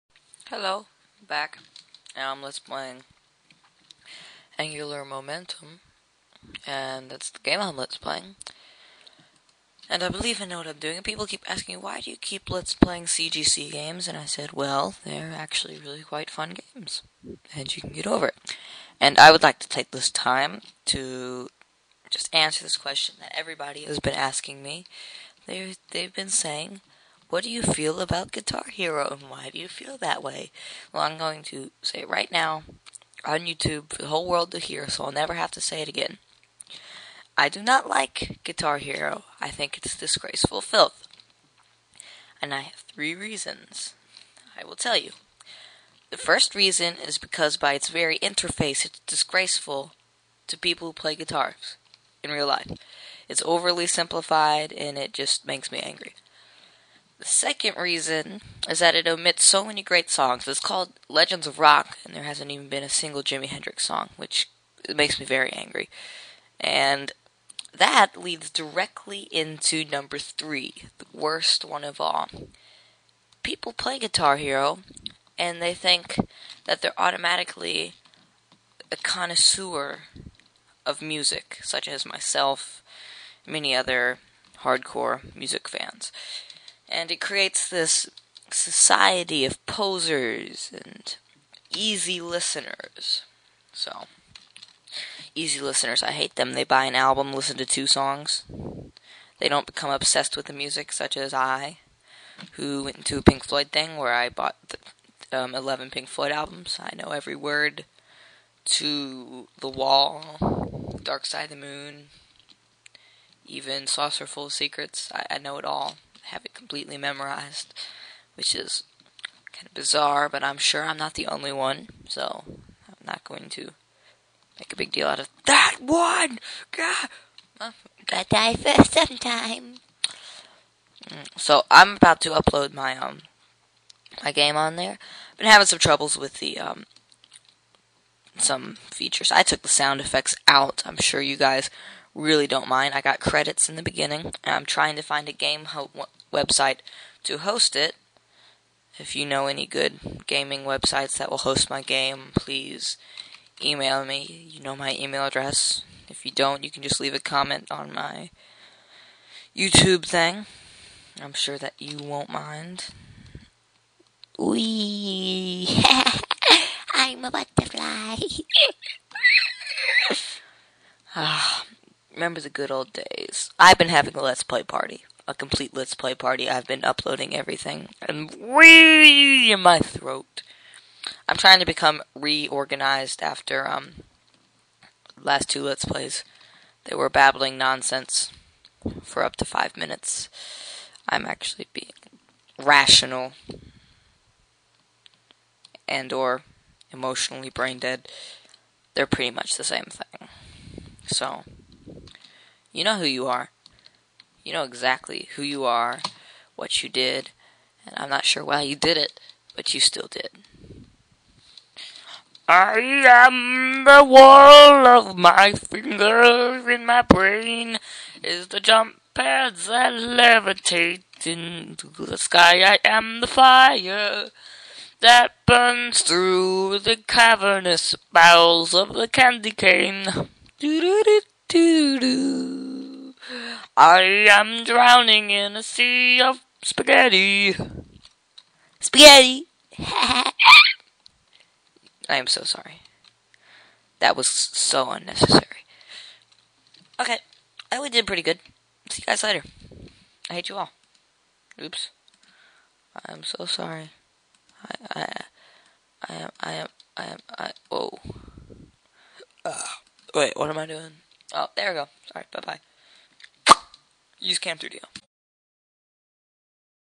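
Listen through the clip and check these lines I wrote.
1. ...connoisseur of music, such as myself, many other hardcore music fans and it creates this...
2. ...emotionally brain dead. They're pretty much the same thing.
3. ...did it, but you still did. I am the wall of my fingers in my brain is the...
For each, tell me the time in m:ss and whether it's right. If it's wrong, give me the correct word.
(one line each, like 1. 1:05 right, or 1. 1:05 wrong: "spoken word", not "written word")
1. 1:18 right
2. 3:16 right
3. 3:28 right.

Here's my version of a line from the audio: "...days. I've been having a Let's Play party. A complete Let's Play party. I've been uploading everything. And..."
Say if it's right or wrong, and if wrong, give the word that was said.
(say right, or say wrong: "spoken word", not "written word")
right.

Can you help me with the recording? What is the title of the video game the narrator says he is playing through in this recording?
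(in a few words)
Angular Momentum.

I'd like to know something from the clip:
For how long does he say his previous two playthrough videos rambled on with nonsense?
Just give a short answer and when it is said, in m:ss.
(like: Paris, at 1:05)
Up to 5 minutes, at 3:09.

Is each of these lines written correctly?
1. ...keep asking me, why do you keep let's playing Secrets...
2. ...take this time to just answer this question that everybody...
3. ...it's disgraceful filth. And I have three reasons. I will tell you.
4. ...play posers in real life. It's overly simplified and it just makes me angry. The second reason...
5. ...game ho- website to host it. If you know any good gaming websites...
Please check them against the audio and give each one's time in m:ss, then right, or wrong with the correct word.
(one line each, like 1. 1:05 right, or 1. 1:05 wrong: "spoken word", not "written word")
1. 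0:11 wrong: "CGC", not "Secrets"
2. 0:19 right
3. 0:39 right
4. 0:50 wrong: "guitars", not "posers"
5. 2:25 right.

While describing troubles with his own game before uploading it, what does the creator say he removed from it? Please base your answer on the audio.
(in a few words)
Sound effects.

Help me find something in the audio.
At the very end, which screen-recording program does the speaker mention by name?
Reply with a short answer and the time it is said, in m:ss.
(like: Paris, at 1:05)
CamStudio, at 4:24.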